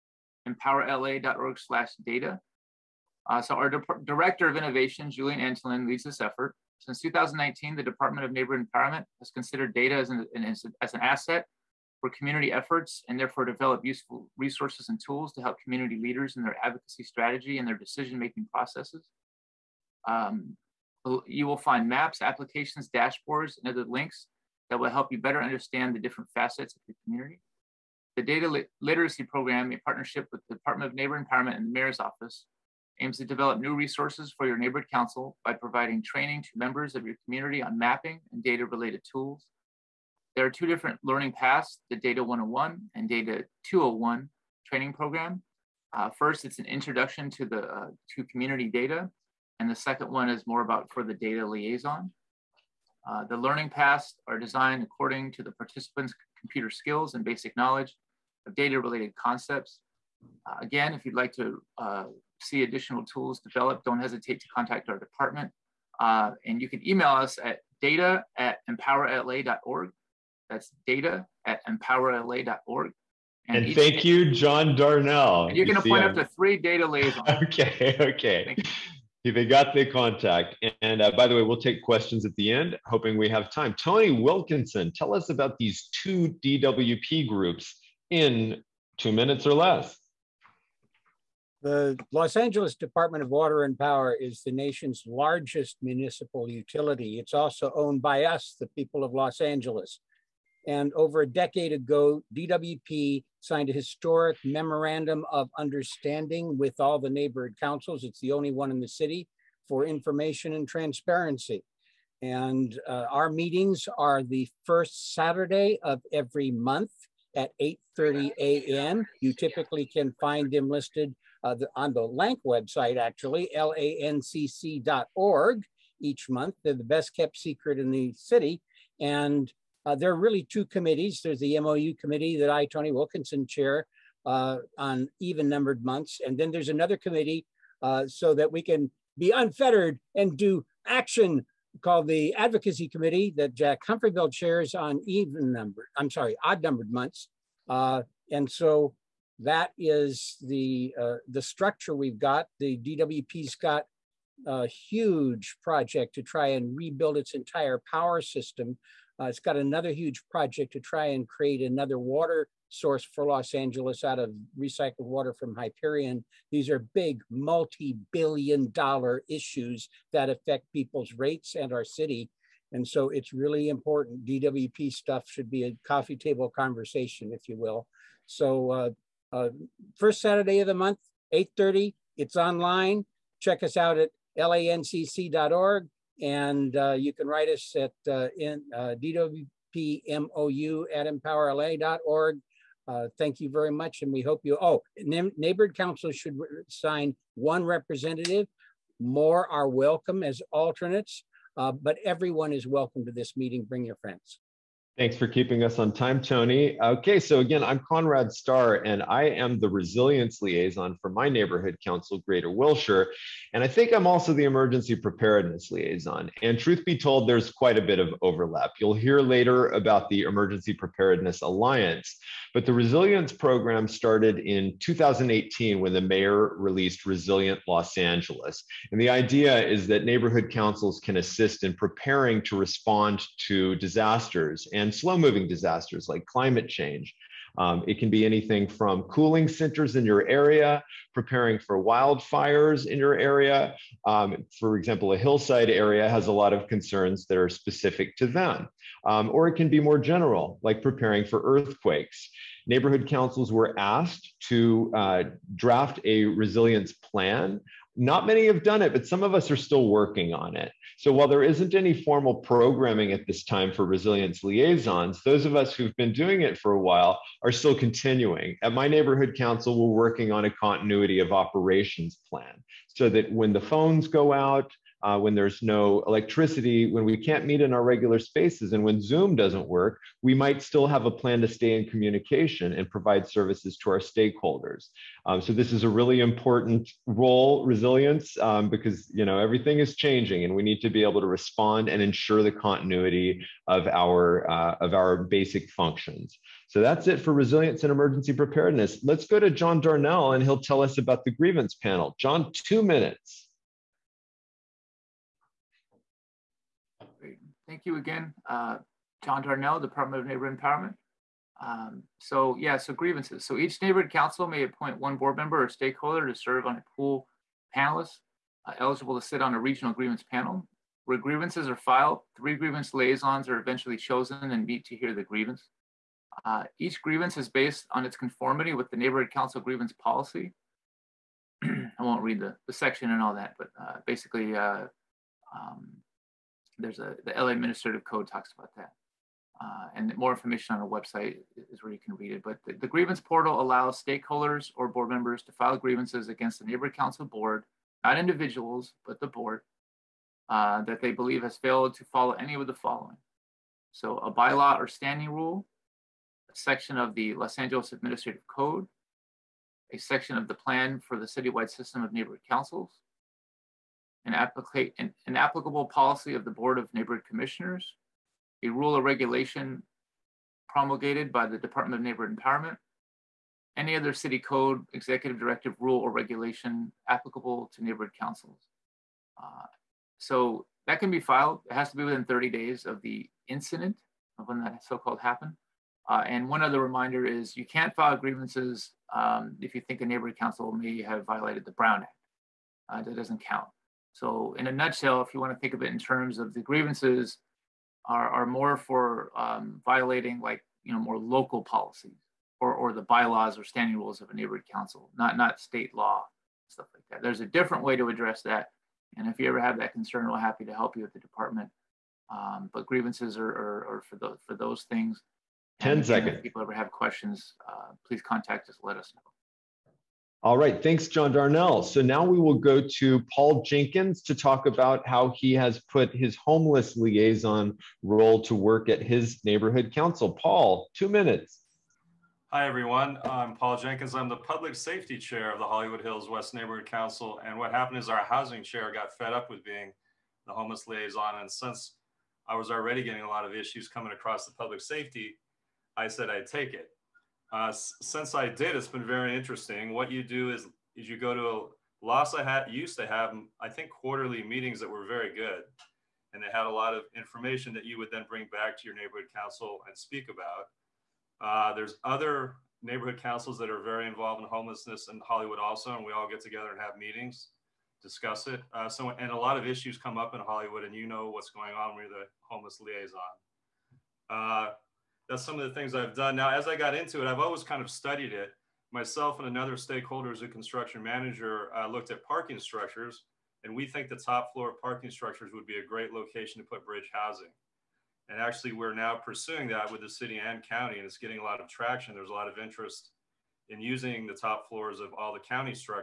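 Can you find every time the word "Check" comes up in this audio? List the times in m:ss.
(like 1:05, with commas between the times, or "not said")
3:03.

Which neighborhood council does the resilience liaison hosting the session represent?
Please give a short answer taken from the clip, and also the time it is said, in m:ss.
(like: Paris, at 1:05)
Greater Wilshire, at 3:32.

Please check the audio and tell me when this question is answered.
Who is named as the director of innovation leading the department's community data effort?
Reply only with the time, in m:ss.
0:05.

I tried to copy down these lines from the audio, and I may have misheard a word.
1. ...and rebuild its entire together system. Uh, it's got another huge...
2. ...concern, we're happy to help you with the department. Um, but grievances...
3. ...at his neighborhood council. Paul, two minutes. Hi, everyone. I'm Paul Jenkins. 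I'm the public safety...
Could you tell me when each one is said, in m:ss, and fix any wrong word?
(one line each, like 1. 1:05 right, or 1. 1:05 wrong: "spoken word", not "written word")
1. 2:36 wrong: "power", not "together"
2. 6:49 right
3. 7:08 right.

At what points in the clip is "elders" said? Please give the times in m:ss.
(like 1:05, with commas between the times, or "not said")
not said.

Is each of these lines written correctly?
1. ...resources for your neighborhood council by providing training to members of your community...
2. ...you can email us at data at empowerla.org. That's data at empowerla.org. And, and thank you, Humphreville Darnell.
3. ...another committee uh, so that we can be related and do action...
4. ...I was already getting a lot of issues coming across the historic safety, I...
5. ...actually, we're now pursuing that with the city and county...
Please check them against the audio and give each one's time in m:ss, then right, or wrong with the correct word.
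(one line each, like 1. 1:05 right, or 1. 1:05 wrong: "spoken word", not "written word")
1. 0:33 right
2. 1:06 wrong: "John", not "Humphreville"
3. 2:16 wrong: "unfettered", not "related"
4. 7:22 wrong: "public", not "historic"
5. 8:08 right.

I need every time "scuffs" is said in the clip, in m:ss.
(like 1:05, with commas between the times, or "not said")
not said.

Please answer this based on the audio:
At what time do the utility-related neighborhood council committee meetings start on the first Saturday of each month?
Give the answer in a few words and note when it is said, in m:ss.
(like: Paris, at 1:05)
8:30 a.m., at 1:57.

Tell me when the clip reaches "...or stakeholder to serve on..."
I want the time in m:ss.
5:15.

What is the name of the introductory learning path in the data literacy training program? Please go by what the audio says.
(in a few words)
Data 101.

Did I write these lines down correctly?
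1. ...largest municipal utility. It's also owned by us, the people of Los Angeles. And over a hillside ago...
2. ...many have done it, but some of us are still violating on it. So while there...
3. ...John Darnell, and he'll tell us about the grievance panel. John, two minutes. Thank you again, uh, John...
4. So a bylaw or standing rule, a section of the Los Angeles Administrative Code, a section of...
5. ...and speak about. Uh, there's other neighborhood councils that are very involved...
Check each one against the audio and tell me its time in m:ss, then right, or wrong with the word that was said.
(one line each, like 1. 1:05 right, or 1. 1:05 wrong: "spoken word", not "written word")
1. 1:35 wrong: "decade", not "hillside"
2. 4:18 wrong: "working", not "violating"
3. 4:59 right
4. 5:53 right
5. 7:39 right.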